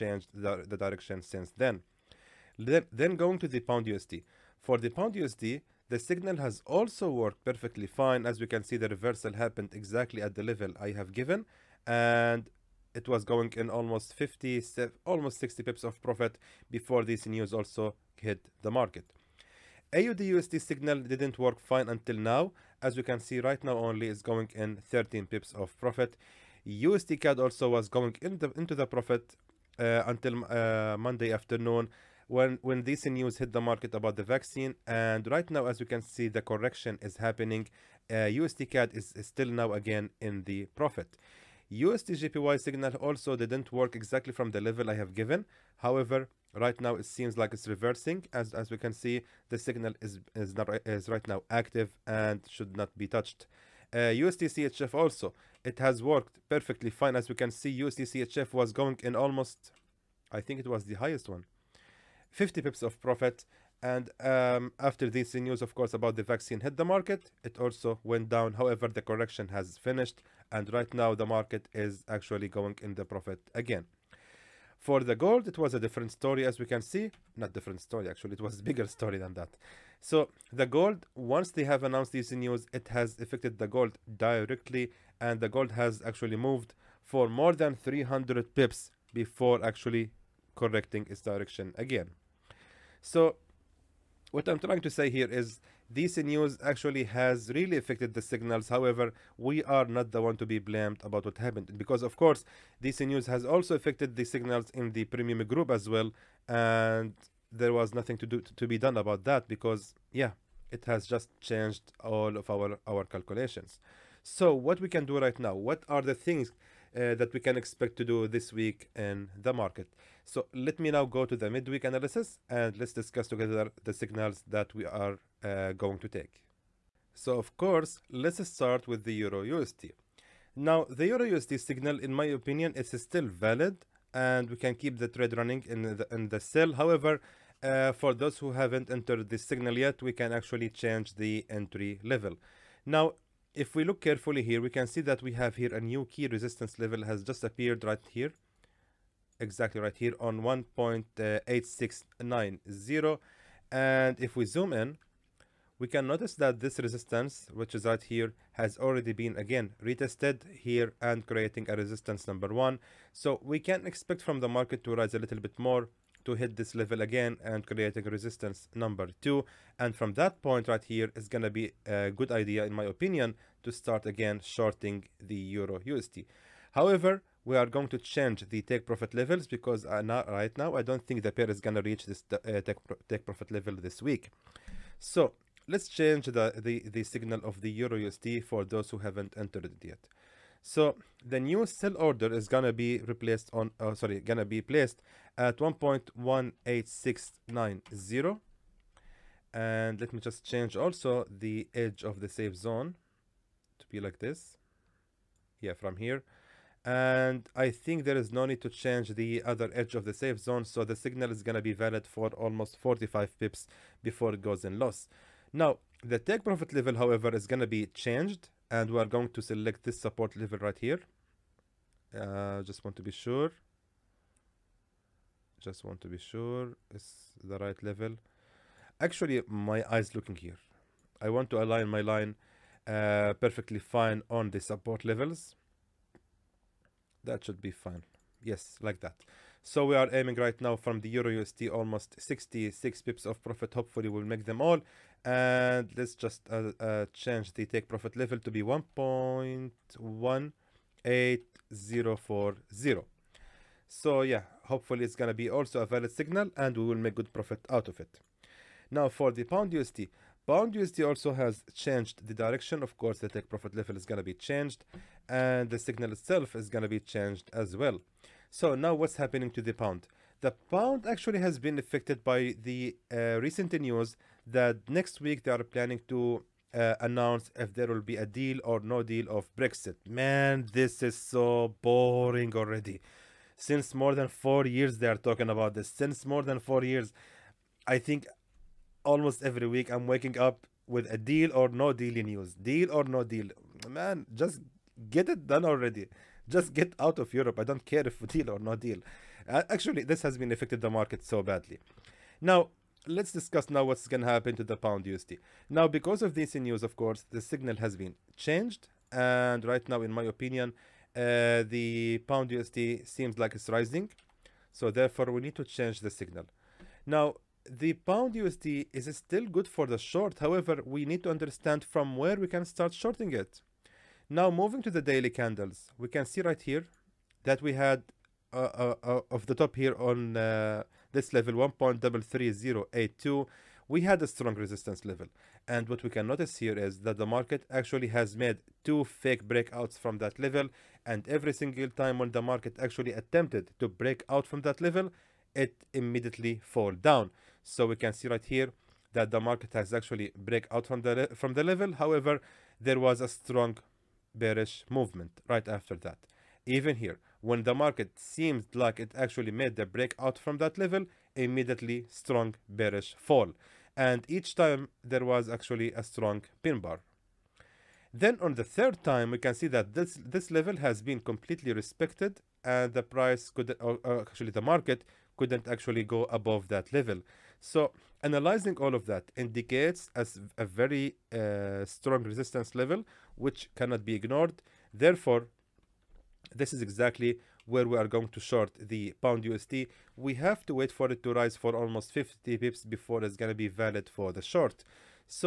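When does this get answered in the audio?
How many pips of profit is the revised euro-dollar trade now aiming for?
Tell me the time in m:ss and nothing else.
4:02.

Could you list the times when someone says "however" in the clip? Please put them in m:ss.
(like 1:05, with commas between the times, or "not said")
0:45, 1:08, 1:38, 2:16, 2:56, 3:36, 5:20, 5:51.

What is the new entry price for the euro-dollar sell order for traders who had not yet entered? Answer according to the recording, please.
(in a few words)
1.18690.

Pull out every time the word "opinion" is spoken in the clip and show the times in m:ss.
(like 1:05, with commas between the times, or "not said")
2:12, 2:52, 5:10.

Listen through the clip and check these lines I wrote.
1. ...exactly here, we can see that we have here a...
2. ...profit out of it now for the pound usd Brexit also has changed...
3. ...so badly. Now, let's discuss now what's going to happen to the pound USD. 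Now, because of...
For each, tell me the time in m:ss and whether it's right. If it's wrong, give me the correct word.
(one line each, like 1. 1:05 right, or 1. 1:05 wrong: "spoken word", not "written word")
1. 2:23 wrong: "carefully", not "exactly"
2. 4:17 wrong: "USD", not "Brexit"
3. 5:01 right.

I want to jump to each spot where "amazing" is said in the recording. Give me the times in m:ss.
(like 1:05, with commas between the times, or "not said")
not said.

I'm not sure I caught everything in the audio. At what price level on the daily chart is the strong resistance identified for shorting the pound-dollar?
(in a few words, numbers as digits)
1.33082.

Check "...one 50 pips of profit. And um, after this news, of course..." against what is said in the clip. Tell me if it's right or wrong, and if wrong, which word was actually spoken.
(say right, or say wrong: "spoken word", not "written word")
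right.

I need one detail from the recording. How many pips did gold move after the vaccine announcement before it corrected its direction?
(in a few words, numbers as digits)
more than 300.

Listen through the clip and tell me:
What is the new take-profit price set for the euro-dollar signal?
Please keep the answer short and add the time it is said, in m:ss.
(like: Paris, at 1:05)
1.18040, at 4:08.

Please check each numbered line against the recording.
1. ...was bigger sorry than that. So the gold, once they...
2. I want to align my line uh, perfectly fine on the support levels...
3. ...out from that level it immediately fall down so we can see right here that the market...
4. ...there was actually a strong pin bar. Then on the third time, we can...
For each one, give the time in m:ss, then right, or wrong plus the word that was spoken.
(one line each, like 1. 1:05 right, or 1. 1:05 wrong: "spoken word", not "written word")
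1. 1:18 wrong: "story", not "sorry"
2. 3:51 right
3. 5:44 right
4. 6:05 right.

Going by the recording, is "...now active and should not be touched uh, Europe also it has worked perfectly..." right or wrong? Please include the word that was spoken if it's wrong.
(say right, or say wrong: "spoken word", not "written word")
wrong: "USDCHF", not "Europe".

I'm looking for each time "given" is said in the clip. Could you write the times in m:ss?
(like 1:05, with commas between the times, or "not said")
0:11, 0:45.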